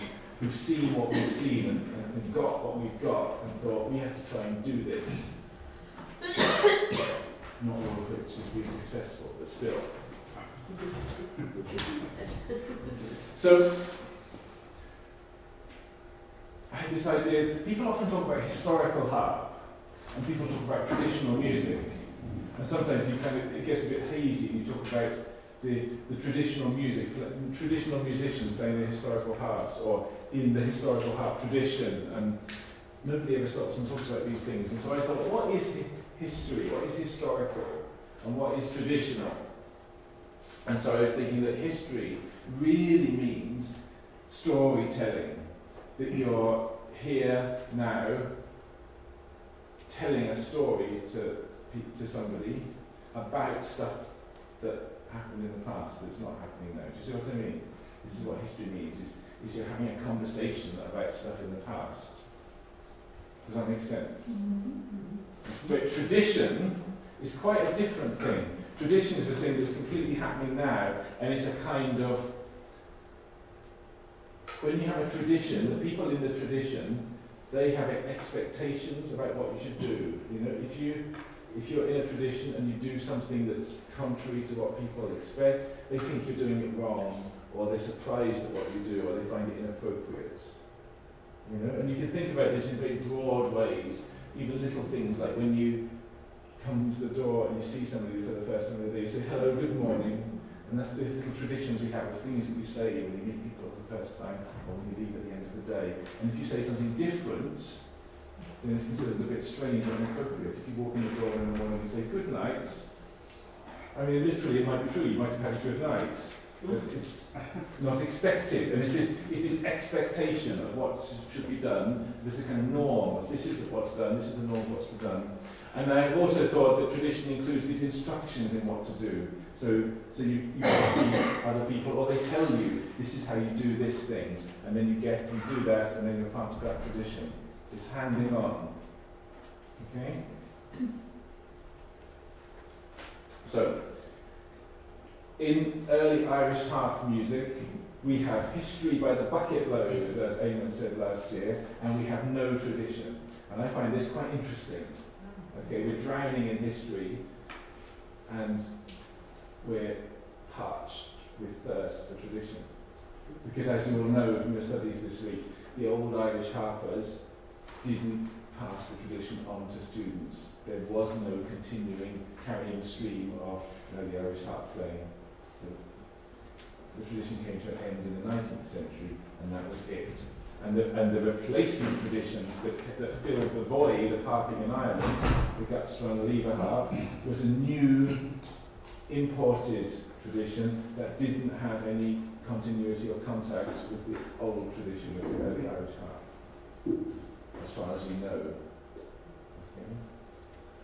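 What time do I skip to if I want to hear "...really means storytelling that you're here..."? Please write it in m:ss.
0:42.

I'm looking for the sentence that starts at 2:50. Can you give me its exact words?
There was no continuing carrying stream of you know, the Irish harp playing.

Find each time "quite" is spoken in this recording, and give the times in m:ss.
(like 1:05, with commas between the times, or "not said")
1:07, 2:34.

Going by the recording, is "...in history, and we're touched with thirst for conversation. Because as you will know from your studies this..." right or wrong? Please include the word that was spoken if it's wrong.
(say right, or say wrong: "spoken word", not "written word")
wrong: "tradition", not "conversation".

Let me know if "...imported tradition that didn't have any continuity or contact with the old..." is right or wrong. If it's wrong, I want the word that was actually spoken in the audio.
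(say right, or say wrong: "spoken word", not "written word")
right.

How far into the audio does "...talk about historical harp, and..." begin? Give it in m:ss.
0:18.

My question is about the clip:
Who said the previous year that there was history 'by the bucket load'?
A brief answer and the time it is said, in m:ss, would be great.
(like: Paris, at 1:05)
Eamon, at 2:30.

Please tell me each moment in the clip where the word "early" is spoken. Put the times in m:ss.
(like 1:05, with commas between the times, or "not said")
2:25, 3:15.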